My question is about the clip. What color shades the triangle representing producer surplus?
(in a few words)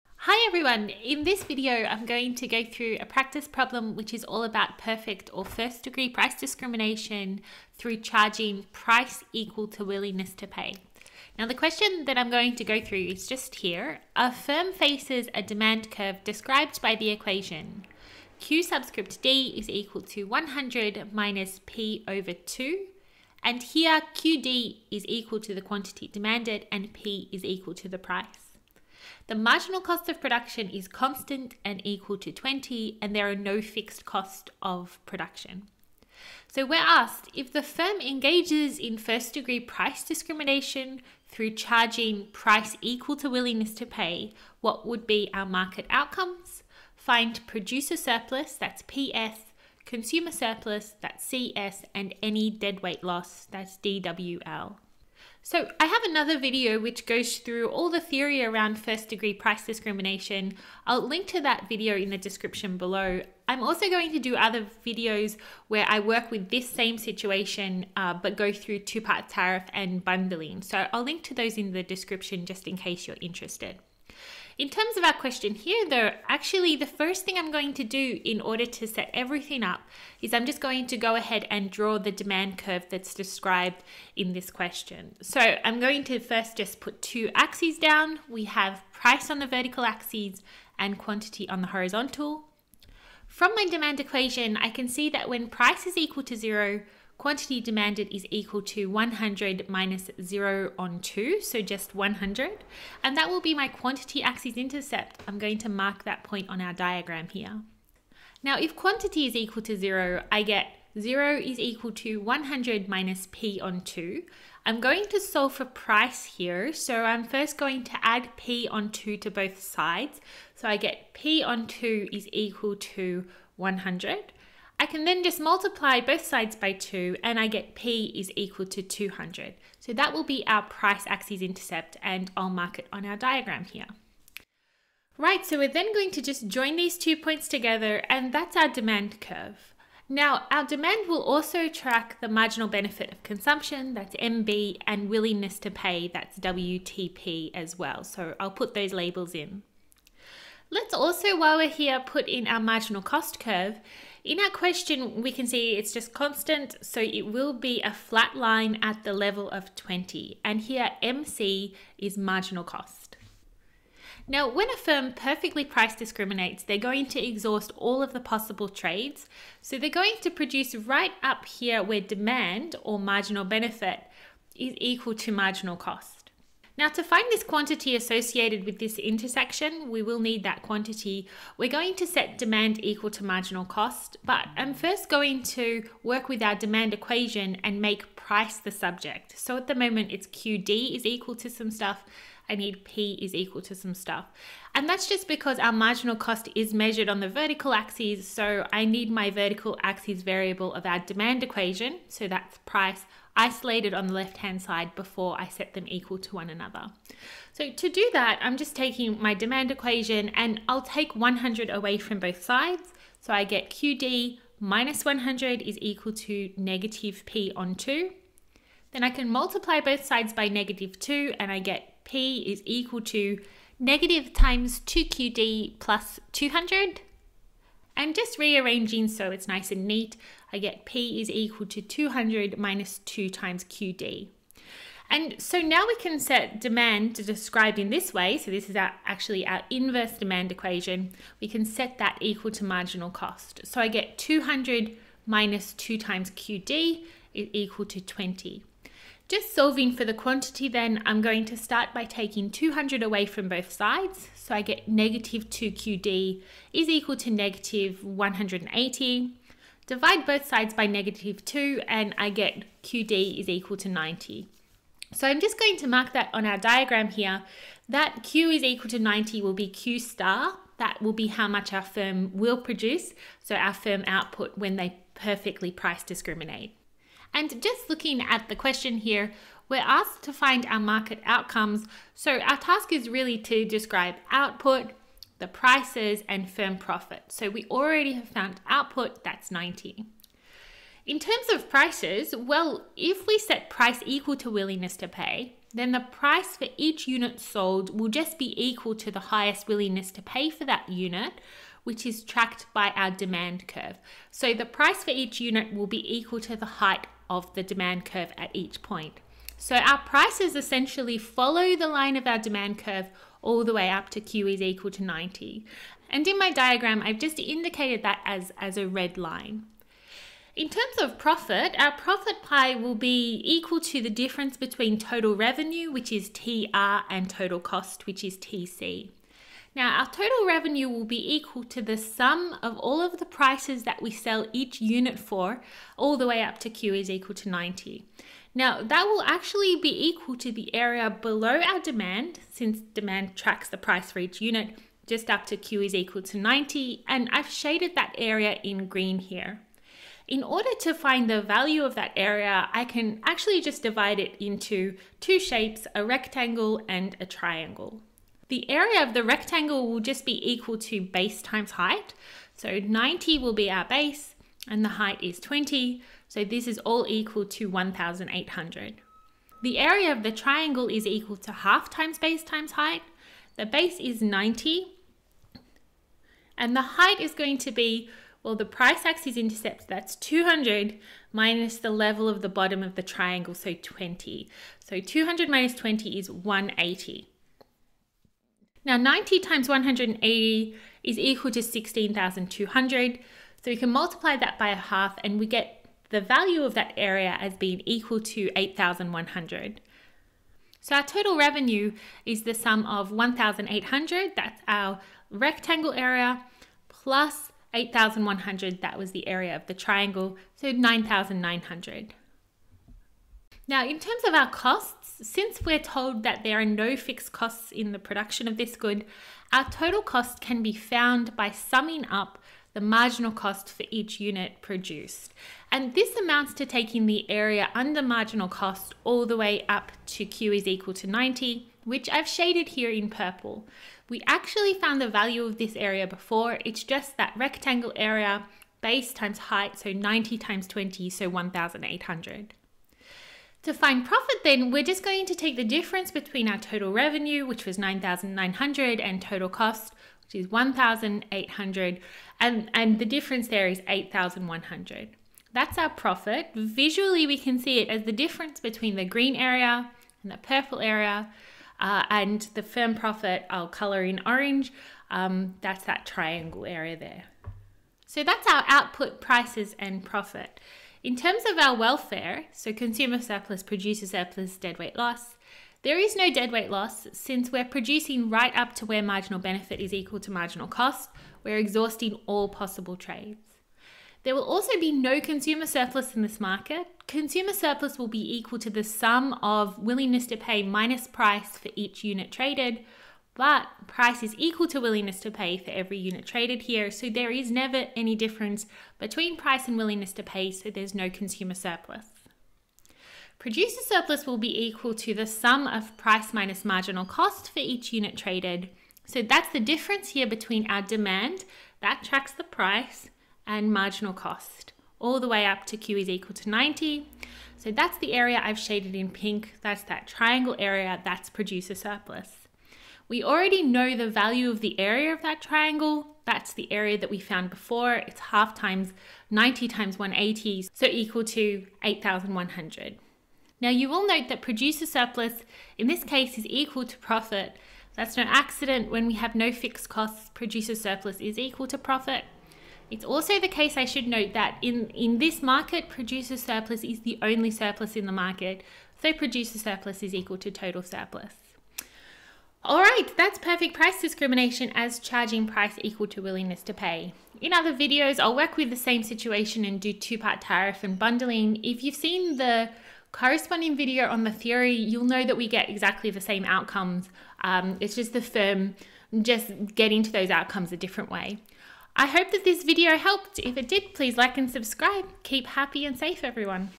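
pink.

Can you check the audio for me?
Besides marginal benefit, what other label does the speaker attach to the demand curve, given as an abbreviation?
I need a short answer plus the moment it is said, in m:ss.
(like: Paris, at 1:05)
WTP, at 2:26.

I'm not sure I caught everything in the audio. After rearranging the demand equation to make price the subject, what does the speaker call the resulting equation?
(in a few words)
inverse demand equation.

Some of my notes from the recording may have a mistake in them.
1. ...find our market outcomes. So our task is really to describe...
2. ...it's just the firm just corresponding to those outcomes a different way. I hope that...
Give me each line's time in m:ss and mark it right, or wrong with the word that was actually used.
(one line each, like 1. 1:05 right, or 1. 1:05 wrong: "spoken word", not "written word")
1. 4:40 right
2. 9:27 wrong: "getting", not "corresponding".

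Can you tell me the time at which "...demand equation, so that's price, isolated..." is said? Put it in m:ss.
3:20.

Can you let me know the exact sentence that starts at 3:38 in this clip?
Then I can multiply both sides by negative 2 and I get P is equal to negative times 2QD plus 200.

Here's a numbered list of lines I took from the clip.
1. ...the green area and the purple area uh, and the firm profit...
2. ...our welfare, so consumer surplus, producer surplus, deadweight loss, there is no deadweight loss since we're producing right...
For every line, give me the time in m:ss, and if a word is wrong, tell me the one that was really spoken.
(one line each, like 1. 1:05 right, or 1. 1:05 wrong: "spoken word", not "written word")
1. 7:38 right
2. 7:51 right.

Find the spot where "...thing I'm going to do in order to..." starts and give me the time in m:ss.
1:17.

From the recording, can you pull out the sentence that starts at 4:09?
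Just solving for the quantity then, I'm going to start by taking 200 away from both sides.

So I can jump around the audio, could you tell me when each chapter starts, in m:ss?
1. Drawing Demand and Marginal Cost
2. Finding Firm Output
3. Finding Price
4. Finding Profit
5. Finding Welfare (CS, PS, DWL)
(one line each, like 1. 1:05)
1. 1:16
2. 2:42
3. 4:50
4. 5:20
5. 7:50.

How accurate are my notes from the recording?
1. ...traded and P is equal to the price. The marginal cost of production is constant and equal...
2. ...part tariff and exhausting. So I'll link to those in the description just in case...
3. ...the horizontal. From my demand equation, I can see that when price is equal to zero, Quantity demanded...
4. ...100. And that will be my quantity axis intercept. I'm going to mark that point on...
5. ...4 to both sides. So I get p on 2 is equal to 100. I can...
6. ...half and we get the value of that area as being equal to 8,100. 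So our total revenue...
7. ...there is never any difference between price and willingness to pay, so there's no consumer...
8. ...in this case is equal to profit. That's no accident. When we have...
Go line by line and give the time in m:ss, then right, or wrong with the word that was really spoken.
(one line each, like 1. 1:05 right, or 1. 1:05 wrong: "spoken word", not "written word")
1. 0:26 wrong: "demanded", not "traded"
2. 1:09 wrong: "bundling", not "exhausting"
3. 1:31 right
4. 1:41 right
5. 1:58 wrong: "2", not "4"
6. 6:34 right
7. 8:17 right
8. 8:55 right.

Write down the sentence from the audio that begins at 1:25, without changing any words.
So I'm going to first just put two axes down.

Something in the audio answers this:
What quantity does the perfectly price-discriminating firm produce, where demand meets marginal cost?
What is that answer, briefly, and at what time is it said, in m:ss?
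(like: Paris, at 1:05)
90, at 4:22.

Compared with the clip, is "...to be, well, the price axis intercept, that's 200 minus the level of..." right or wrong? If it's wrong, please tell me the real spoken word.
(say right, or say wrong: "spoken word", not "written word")
right.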